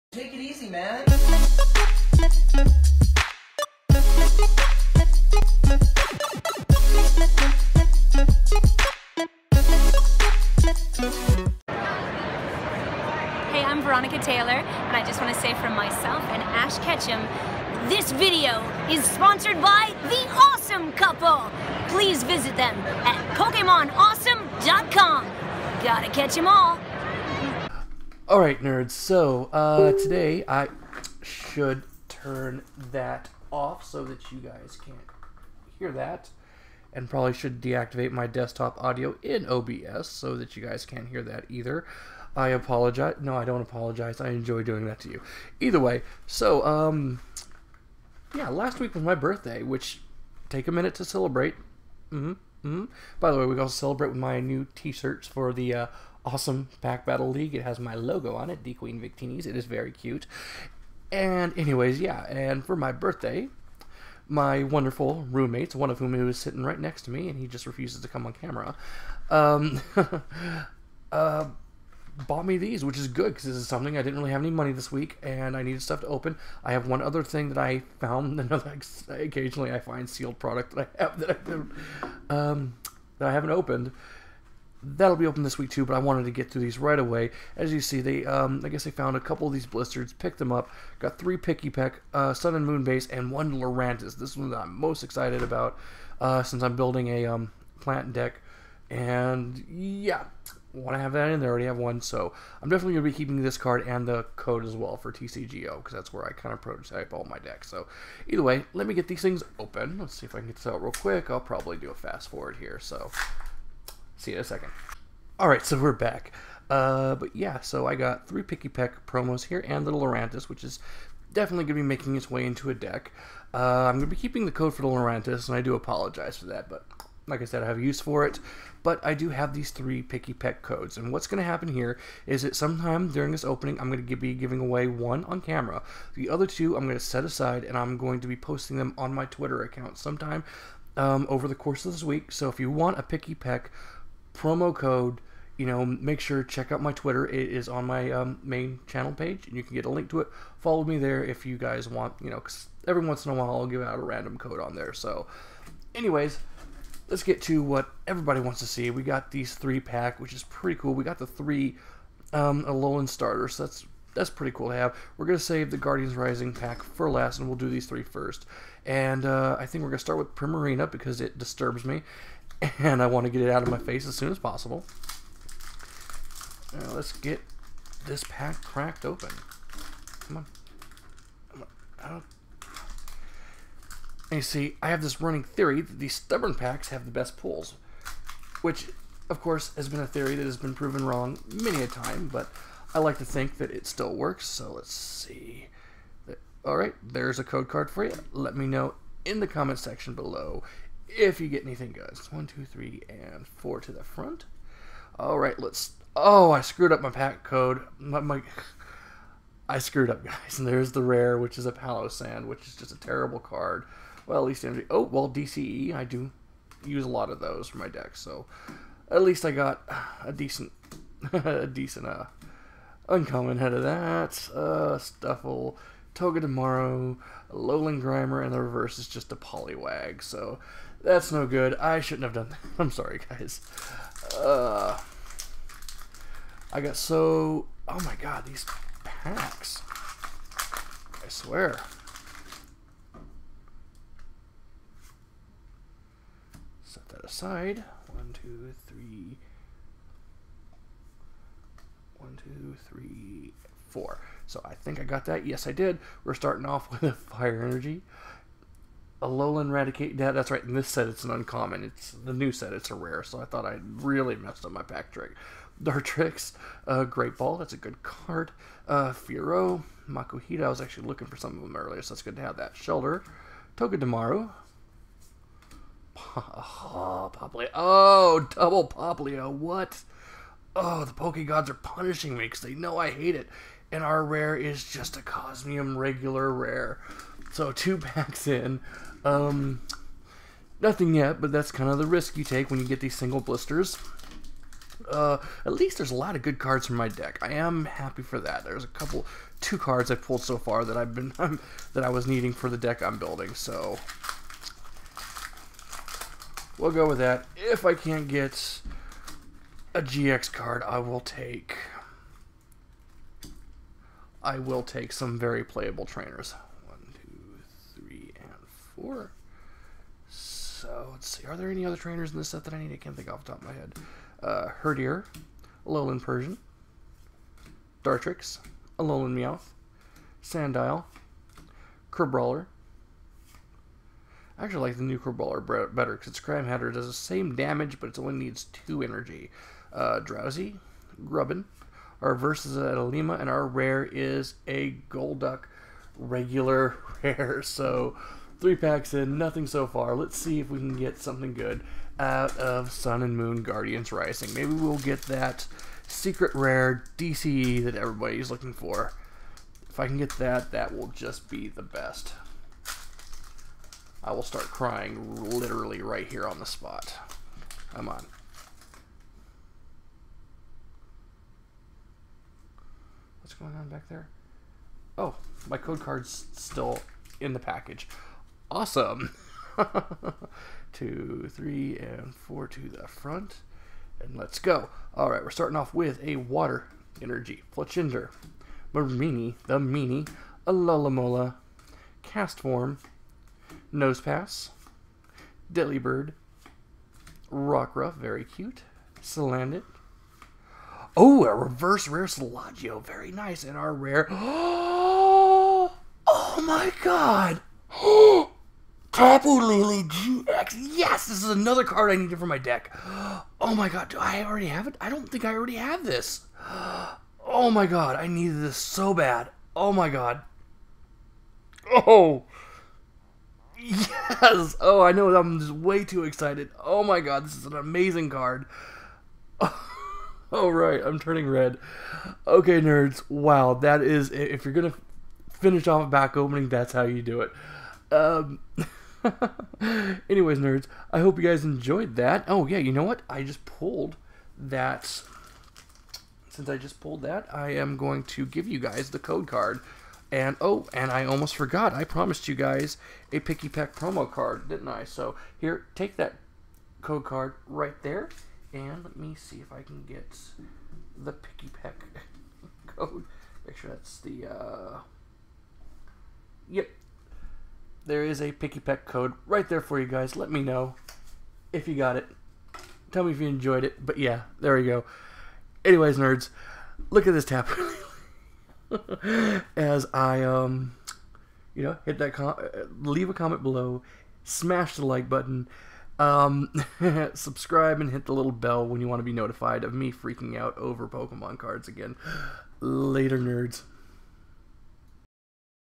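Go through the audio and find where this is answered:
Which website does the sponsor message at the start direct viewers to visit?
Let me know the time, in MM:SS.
00:23.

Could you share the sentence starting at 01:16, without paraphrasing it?
I have one other thing that I found.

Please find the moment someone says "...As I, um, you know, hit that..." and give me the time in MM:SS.
07:59.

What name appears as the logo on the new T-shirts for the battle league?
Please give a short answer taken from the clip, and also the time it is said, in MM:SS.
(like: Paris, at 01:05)
D Queen Victinis, at 00:58.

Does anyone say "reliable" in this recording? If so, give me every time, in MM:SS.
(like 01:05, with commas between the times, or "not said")
not said.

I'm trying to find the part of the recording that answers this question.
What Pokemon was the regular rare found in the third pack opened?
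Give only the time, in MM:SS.
05:45.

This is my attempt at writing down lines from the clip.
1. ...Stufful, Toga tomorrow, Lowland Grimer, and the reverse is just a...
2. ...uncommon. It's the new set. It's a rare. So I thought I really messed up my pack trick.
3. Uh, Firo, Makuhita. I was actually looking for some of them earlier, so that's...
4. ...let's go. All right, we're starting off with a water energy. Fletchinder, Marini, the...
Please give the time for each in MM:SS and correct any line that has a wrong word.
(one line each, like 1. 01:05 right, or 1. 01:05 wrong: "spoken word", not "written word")
1. 03:44 right
2. 04:21 right
3. 04:28 right
4. 06:24 right.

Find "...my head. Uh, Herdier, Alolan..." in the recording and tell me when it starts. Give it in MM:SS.
05:23.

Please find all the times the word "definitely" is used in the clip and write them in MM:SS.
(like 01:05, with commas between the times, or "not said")
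01:42, 02:01.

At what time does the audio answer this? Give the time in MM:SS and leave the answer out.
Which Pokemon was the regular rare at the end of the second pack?
04:45.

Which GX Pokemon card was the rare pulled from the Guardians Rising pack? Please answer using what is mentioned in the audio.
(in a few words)
Tapu Lele GX.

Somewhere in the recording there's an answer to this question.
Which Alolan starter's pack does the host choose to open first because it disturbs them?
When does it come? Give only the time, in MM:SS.
02:50.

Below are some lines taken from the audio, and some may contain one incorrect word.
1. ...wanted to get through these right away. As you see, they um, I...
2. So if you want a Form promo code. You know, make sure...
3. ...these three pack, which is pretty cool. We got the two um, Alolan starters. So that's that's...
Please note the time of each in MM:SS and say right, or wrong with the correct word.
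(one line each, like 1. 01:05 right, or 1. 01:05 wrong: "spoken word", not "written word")
1. 01:25 right
2. 02:22 wrong: "Pikipek", not "Form"
3. 02:39 wrong: "three", not "two".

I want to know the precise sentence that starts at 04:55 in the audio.
Uh, at least there's a lot of good cards from my deck.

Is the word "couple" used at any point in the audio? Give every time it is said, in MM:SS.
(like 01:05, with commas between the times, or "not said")
00:20, 01:29, 04:58.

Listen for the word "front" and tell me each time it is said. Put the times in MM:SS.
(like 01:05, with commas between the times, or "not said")
03:24, 06:23.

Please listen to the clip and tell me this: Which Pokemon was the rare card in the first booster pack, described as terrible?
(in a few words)
Palossand.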